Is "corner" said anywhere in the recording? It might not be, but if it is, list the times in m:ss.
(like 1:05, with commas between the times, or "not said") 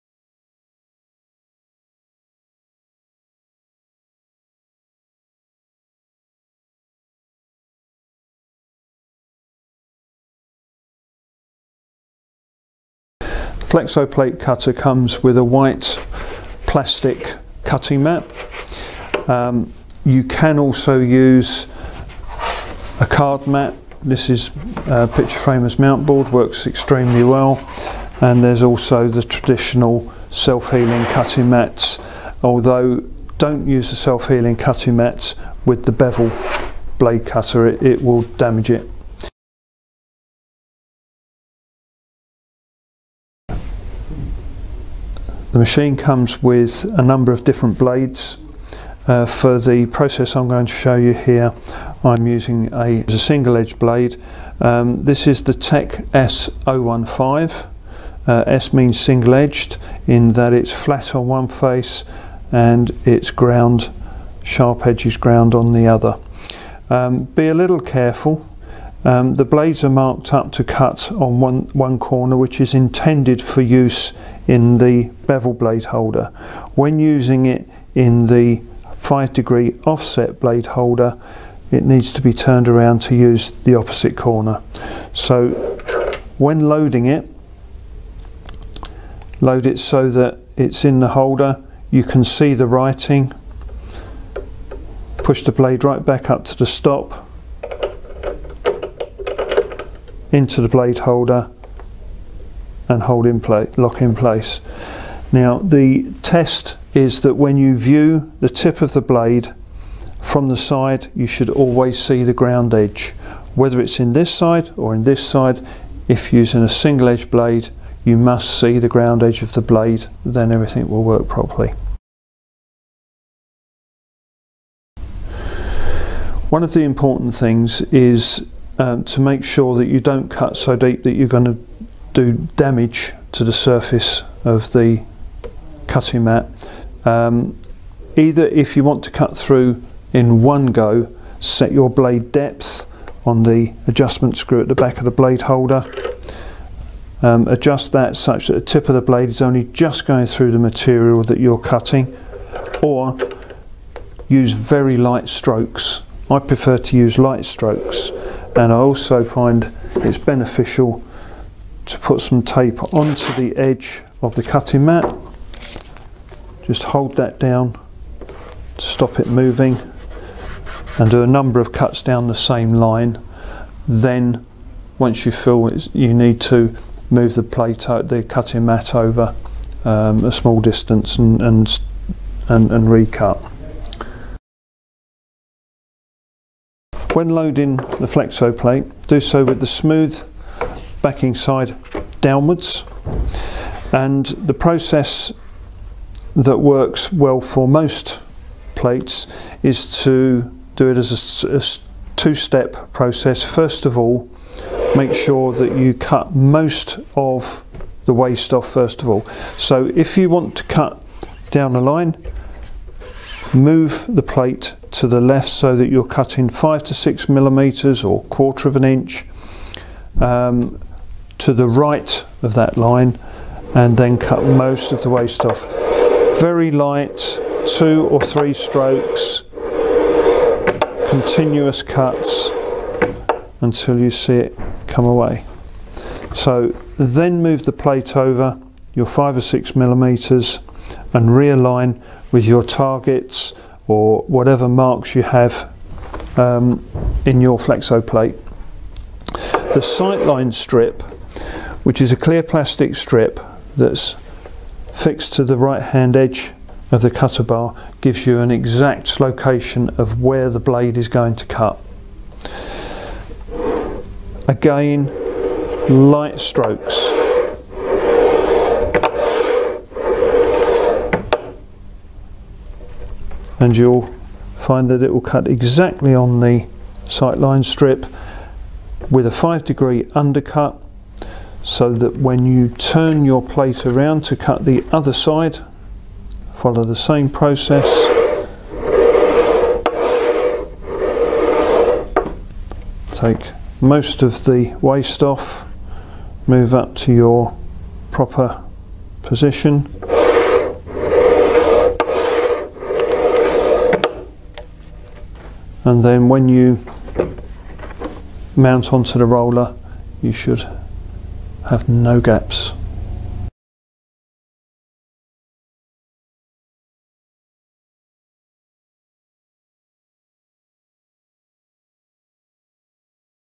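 1:11, 1:24.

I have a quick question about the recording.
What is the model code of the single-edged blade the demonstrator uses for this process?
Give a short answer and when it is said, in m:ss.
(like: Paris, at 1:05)
Tech S015, at 0:55.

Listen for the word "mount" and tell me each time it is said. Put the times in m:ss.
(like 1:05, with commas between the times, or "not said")
0:25, 5:08.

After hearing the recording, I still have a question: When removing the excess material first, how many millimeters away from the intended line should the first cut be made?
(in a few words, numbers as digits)
5 to 6 millimeters.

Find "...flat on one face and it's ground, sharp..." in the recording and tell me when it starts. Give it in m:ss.
1:00.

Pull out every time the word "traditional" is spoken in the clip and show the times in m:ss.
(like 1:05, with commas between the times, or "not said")
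0:29.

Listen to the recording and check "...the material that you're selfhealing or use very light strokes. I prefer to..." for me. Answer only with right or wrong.
wrong.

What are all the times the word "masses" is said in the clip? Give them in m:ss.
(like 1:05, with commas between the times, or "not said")
not said.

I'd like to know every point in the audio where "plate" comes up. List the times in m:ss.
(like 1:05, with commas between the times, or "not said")
0:14, 2:57, 3:08, 3:18, 3:34, 3:57, 4:08, 4:43.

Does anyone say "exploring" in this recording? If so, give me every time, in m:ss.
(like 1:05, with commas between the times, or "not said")
not said.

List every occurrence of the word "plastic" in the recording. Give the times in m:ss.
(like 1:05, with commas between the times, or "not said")
0:16, 4:12.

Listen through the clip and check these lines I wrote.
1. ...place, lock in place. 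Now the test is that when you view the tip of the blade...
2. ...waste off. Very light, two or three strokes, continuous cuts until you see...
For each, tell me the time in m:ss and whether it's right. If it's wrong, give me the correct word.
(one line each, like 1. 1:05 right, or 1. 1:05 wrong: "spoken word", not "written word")
1. 1:43 right
2. 3:45 right.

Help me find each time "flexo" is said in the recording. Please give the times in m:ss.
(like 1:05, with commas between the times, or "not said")
0:13, 3:08, 4:07.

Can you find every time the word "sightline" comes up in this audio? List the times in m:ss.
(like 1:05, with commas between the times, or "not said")
4:09, 4:37.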